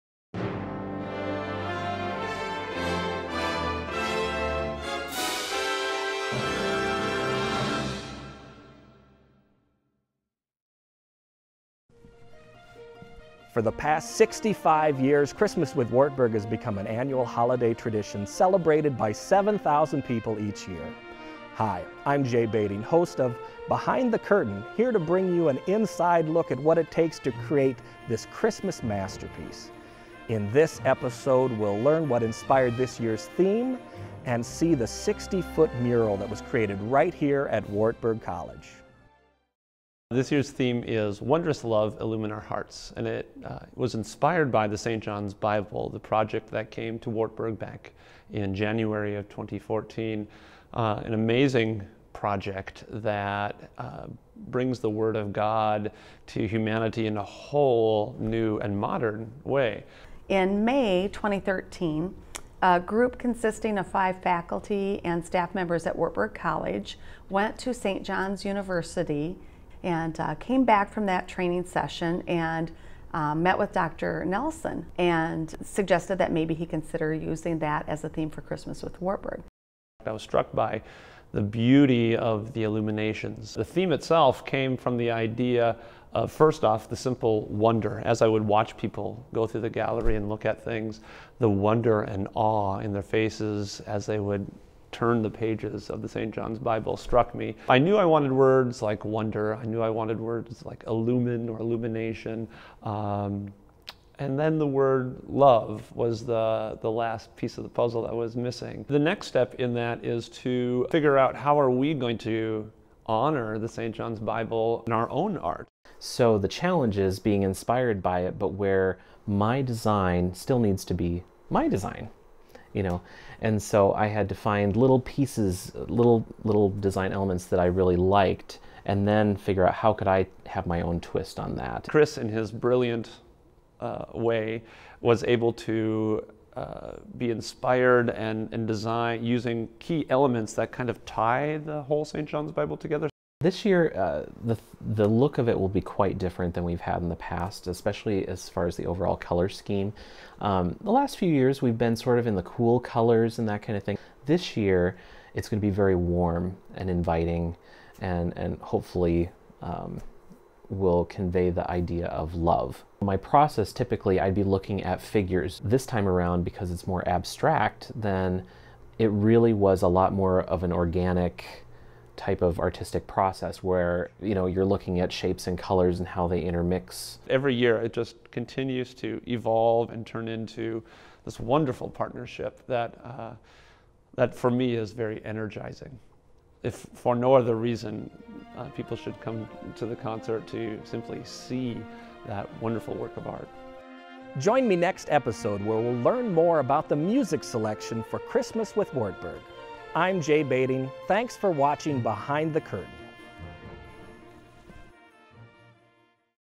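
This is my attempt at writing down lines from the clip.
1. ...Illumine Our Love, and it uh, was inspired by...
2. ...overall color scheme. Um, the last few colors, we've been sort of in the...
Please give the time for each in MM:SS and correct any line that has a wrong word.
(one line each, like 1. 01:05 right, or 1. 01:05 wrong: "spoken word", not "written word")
1. 00:42 wrong: "Hearts", not "Love"
2. 02:28 wrong: "years", not "colors".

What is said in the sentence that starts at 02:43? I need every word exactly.
My process, typically, I'd be looking at figures.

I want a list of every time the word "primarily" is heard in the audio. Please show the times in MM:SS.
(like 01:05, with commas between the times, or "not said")
not said.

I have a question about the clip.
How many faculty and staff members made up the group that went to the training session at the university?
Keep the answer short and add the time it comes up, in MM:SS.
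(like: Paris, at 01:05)
5, at 01:03.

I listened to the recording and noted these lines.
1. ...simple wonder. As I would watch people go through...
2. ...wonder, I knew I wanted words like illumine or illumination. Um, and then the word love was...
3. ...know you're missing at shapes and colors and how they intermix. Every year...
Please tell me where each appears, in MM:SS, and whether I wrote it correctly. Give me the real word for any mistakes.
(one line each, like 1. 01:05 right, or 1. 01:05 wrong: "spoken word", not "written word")
1. 01:26 right
2. 01:39 right
3. 02:54 wrong: "looking", not "missing".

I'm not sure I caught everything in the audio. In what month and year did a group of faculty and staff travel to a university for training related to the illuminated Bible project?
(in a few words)
May 2013.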